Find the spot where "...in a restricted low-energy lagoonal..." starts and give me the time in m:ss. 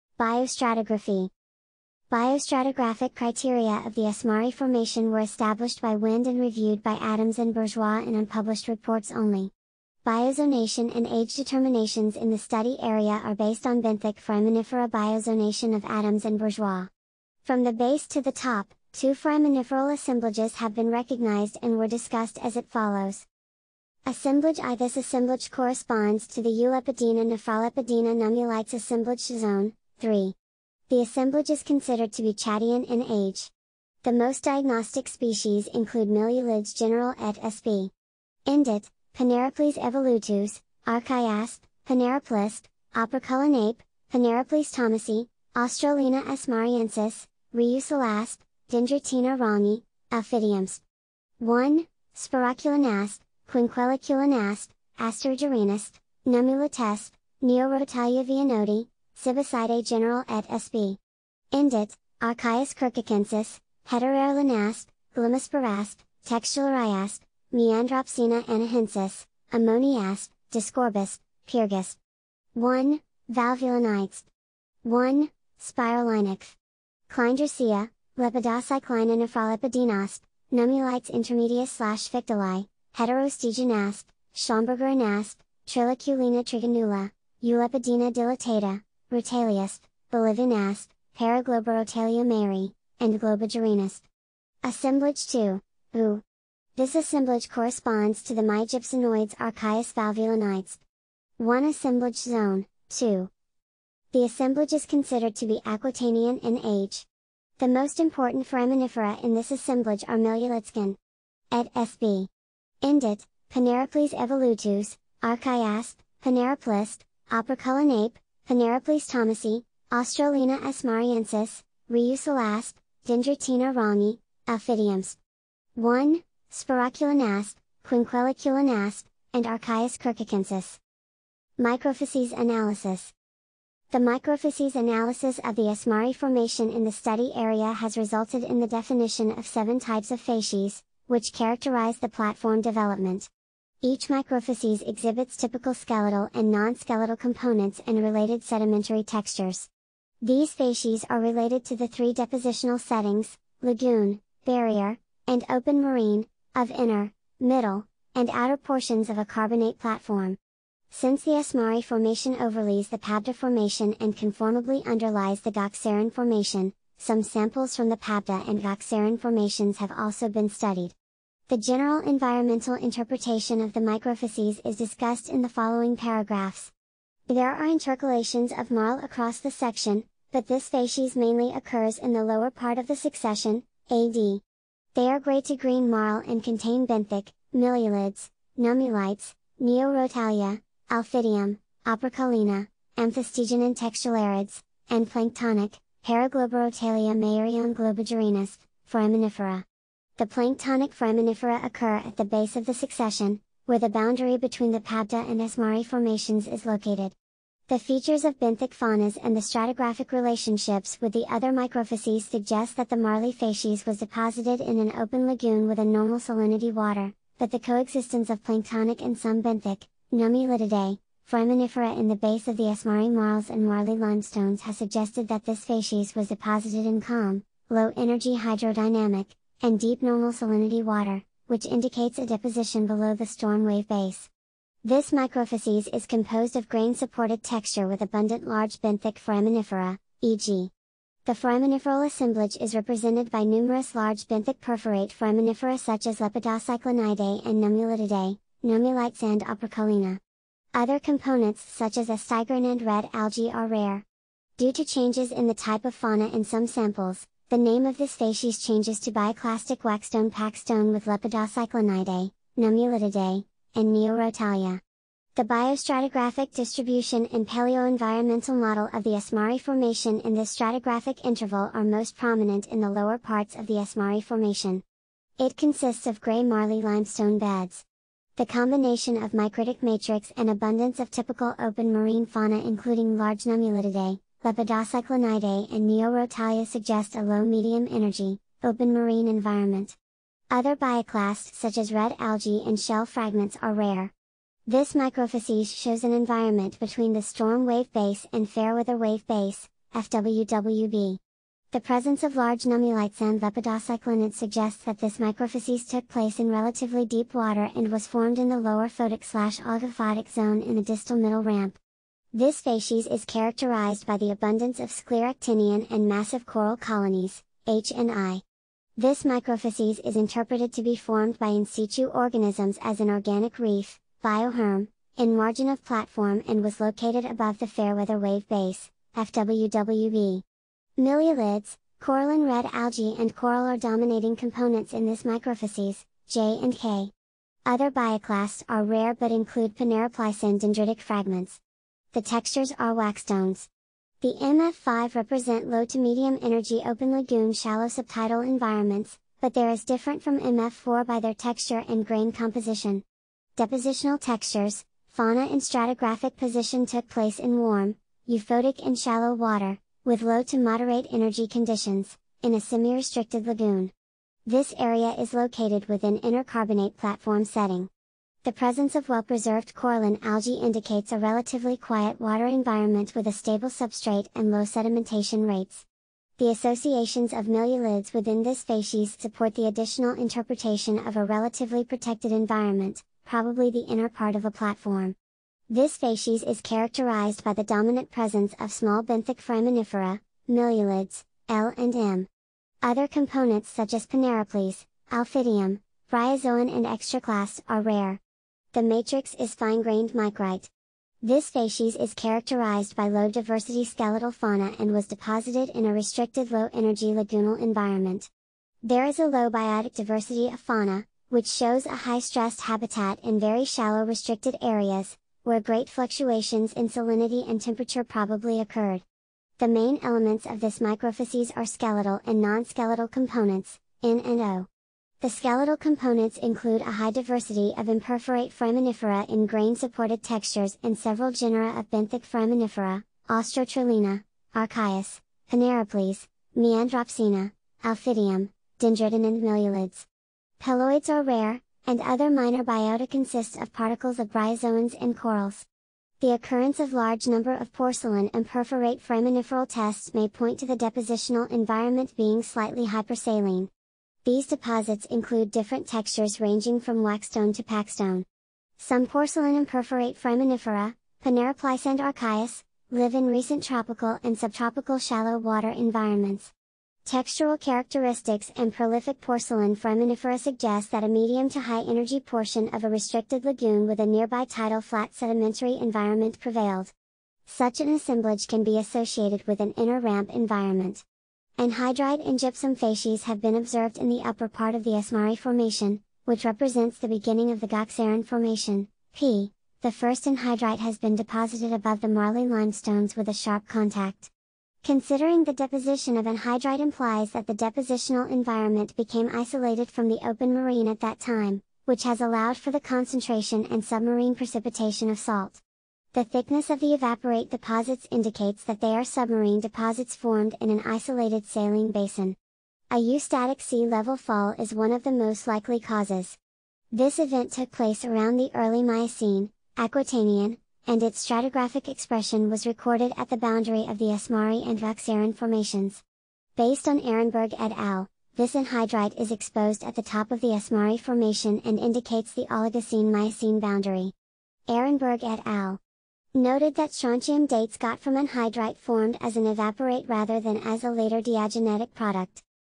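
6:45.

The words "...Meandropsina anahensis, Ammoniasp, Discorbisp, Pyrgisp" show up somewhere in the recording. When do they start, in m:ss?
1:07.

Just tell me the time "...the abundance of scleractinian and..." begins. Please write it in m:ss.
5:14.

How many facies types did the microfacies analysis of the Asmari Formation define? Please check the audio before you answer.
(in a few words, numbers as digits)
7.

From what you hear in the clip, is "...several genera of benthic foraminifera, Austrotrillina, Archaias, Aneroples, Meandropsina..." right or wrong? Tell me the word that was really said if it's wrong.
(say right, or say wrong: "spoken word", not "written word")
right.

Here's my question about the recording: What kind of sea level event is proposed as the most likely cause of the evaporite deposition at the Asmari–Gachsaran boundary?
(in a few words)
Eustatic sea level fall.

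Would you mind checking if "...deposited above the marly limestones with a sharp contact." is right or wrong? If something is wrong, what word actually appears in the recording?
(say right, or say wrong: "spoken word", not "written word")
right.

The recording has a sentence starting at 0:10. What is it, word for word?
Biozonation and age determinations in the study area are based on benthic foraminifera biozonation of Adams and Bourgeois.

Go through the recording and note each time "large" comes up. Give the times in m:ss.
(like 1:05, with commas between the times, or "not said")
3:58, 4:03, 4:43, 5:02, 7:26.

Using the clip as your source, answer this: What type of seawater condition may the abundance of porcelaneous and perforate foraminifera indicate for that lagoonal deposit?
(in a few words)
Slightly hypersaline.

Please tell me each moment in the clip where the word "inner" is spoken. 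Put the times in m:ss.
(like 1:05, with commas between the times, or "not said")
2:36, 6:23, 7:59.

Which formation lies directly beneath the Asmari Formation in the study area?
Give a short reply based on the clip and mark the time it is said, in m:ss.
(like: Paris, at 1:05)
Pabda Formation, at 2:42.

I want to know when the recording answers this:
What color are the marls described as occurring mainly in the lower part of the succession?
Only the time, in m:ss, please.
3:05.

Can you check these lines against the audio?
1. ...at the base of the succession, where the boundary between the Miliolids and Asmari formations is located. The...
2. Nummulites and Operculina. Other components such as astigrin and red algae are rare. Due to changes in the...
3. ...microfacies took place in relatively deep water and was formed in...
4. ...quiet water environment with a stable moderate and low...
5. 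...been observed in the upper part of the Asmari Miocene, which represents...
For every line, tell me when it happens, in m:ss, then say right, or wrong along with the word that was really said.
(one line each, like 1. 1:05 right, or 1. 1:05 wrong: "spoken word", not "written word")
1. 3:21 wrong: "Pabda", not "Miliolids"
2. 4:08 right
3. 5:05 right
4. 6:11 wrong: "substrate", not "moderate"
5. 8:03 wrong: "Formation", not "Miocene".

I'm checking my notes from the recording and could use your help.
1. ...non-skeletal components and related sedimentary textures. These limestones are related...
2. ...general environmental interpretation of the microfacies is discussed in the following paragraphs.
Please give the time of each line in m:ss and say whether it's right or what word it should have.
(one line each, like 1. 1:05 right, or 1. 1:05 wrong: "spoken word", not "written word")
1. 2:26 wrong: "facies", not "limestones"
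2. 2:51 right.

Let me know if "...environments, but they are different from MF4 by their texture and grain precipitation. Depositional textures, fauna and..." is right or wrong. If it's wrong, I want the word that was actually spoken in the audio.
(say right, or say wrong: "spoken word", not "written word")
wrong: "composition", not "precipitation".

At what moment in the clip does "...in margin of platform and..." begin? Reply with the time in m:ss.
5:25.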